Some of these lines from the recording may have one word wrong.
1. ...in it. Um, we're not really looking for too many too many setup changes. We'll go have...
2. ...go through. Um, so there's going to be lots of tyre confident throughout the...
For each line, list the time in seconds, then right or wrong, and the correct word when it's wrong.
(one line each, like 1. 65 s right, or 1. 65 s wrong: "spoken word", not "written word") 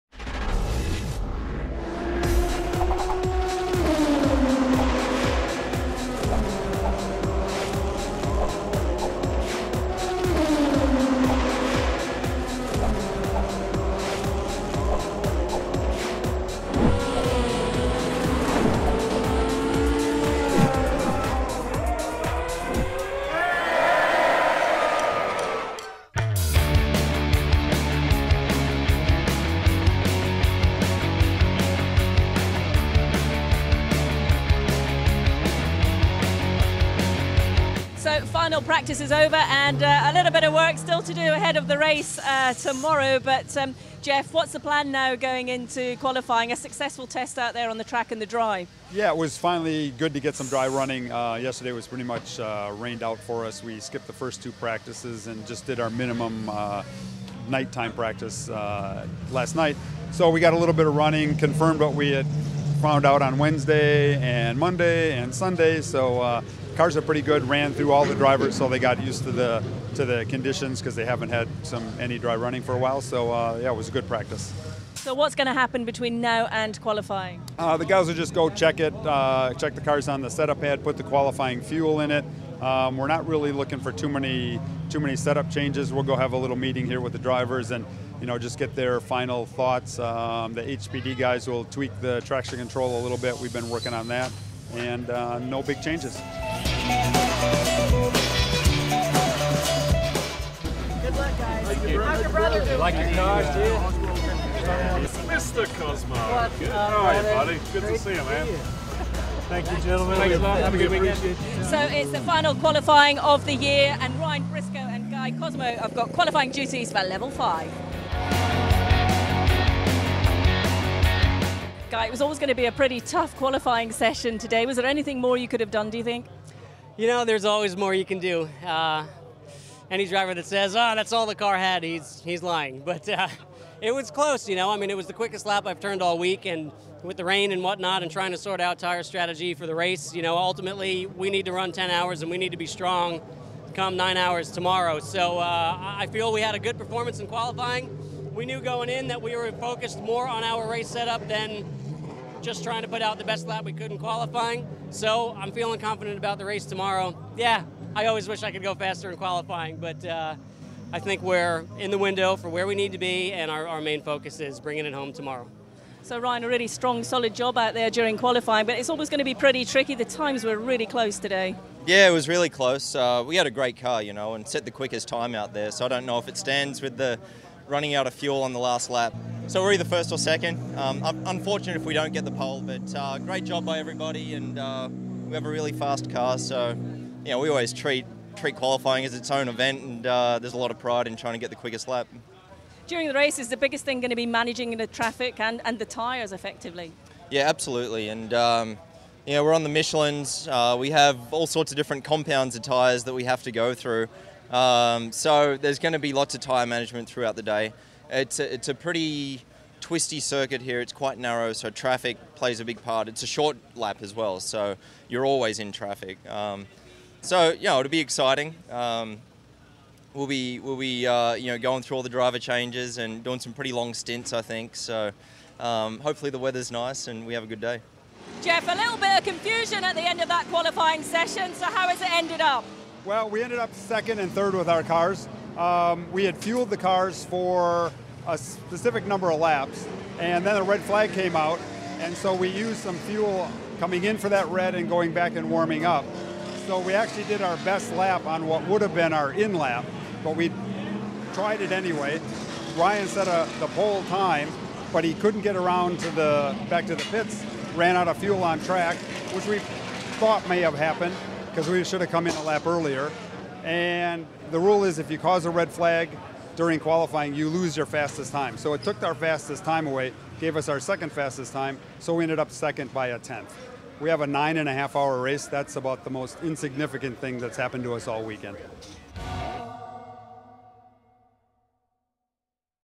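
1. 82 s right
2. 203 s wrong: "management", not "confident".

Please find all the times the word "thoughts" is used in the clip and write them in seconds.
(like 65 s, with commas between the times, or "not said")
89 s, 260 s.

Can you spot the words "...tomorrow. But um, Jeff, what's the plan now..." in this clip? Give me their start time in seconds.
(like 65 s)
42 s.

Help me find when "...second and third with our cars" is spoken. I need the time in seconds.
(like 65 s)
233 s.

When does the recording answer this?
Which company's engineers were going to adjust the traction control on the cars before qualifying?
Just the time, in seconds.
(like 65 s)
90 s.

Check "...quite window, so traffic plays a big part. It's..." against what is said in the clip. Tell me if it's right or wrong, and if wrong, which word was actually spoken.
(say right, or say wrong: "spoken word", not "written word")
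wrong: "narrow", not "window".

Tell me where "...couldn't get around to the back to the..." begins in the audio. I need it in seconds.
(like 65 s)
255 s.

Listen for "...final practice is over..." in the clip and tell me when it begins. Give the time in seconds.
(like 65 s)
38 s.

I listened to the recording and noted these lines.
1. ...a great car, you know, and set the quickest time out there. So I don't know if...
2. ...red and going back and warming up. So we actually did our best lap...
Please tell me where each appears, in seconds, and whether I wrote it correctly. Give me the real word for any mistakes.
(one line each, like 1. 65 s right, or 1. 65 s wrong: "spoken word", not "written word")
1. 173 s right
2. 244 s right.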